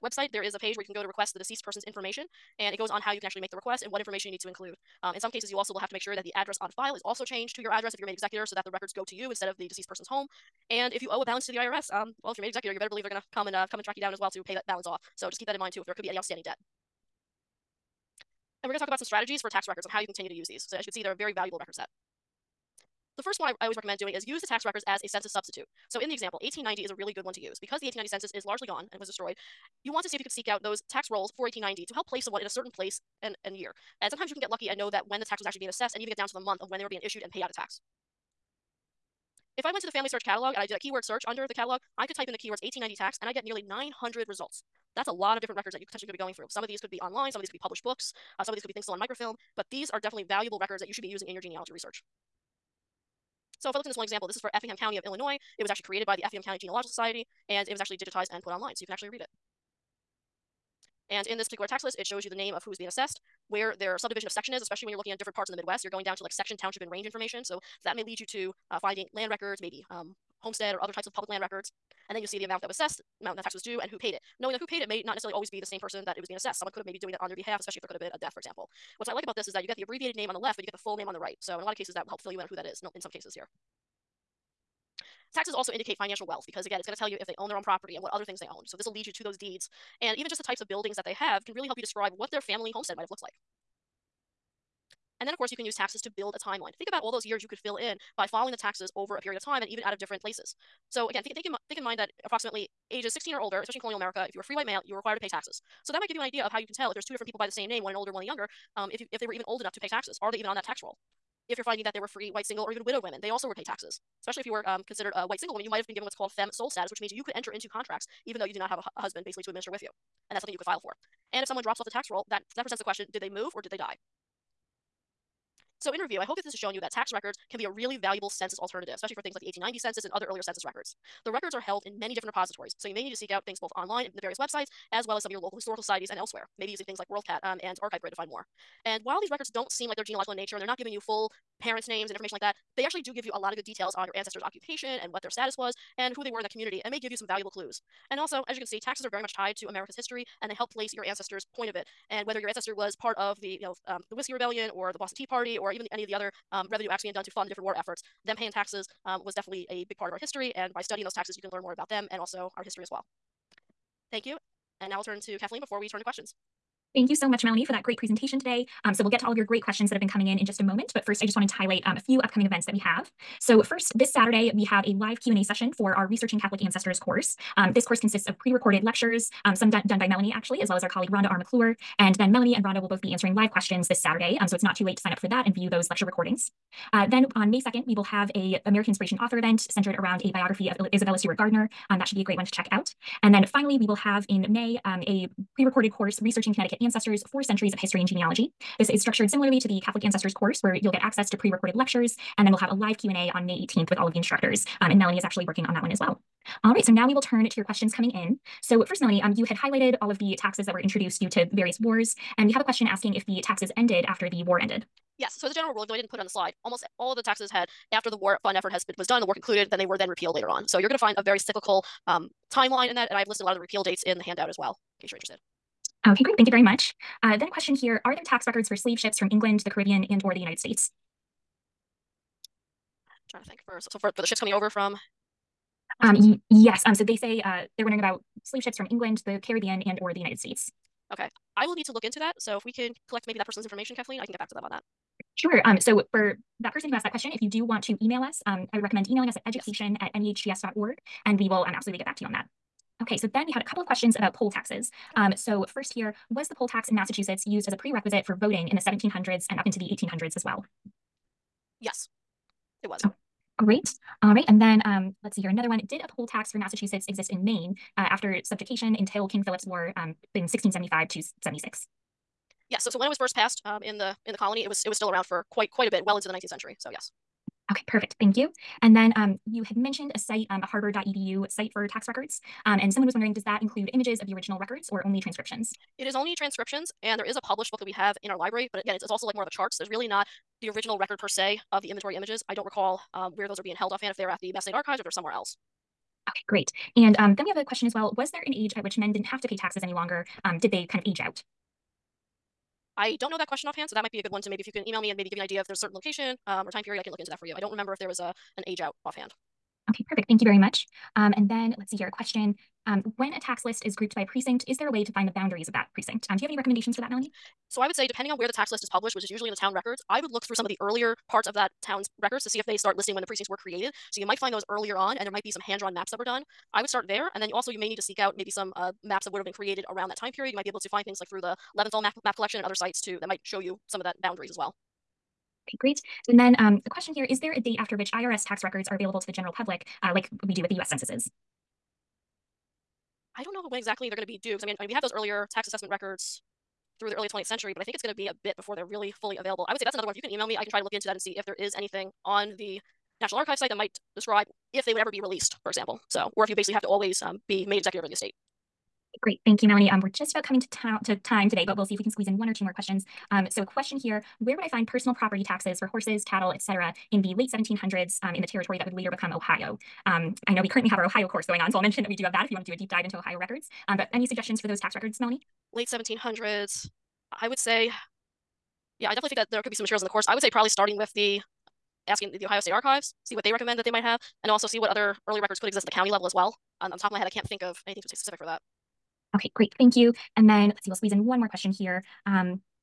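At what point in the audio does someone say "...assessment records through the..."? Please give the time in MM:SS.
05:45.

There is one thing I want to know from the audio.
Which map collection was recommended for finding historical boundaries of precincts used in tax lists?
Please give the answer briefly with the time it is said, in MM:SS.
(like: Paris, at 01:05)
Leventhal, at 05:31.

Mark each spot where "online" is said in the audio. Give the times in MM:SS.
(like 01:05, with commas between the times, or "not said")
00:47, 00:58, 02:13.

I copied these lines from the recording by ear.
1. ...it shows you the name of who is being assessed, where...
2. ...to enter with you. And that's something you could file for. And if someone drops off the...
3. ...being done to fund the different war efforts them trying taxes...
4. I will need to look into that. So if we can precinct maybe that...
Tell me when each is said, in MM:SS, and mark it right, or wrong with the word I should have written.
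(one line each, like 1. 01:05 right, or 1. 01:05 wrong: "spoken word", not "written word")
1. 01:01 right
2. 01:59 wrong: "administer", not "enter"
3. 02:37 wrong: "paying", not "trying"
4. 04:01 wrong: "collect", not "precinct".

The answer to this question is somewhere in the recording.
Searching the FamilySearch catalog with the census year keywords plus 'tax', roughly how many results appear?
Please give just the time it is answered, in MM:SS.
00:43.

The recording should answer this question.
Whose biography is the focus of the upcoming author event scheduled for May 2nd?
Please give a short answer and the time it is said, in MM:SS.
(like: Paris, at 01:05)
Isabella Stewart Gardner, at 03:10.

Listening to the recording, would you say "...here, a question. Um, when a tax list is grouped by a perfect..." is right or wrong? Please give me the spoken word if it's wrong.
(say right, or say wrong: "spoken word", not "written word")
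wrong: "precinct", not "perfect".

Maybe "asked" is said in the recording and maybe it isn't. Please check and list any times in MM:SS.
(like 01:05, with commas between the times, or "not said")
04:06.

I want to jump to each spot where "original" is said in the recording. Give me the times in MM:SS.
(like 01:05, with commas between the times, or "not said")
04:44, 04:50.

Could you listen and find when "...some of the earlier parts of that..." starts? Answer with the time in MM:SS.
05:20.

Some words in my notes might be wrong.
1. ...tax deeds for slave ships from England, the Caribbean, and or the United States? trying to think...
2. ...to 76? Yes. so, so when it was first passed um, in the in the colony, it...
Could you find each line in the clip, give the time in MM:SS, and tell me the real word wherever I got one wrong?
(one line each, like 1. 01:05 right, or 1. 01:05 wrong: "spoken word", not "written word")
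1. 03:48 wrong: "records", not "deeds"
2. 04:31 right.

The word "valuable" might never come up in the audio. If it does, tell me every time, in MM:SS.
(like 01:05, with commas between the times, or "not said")
00:21, 00:50, 02:07, 02:27.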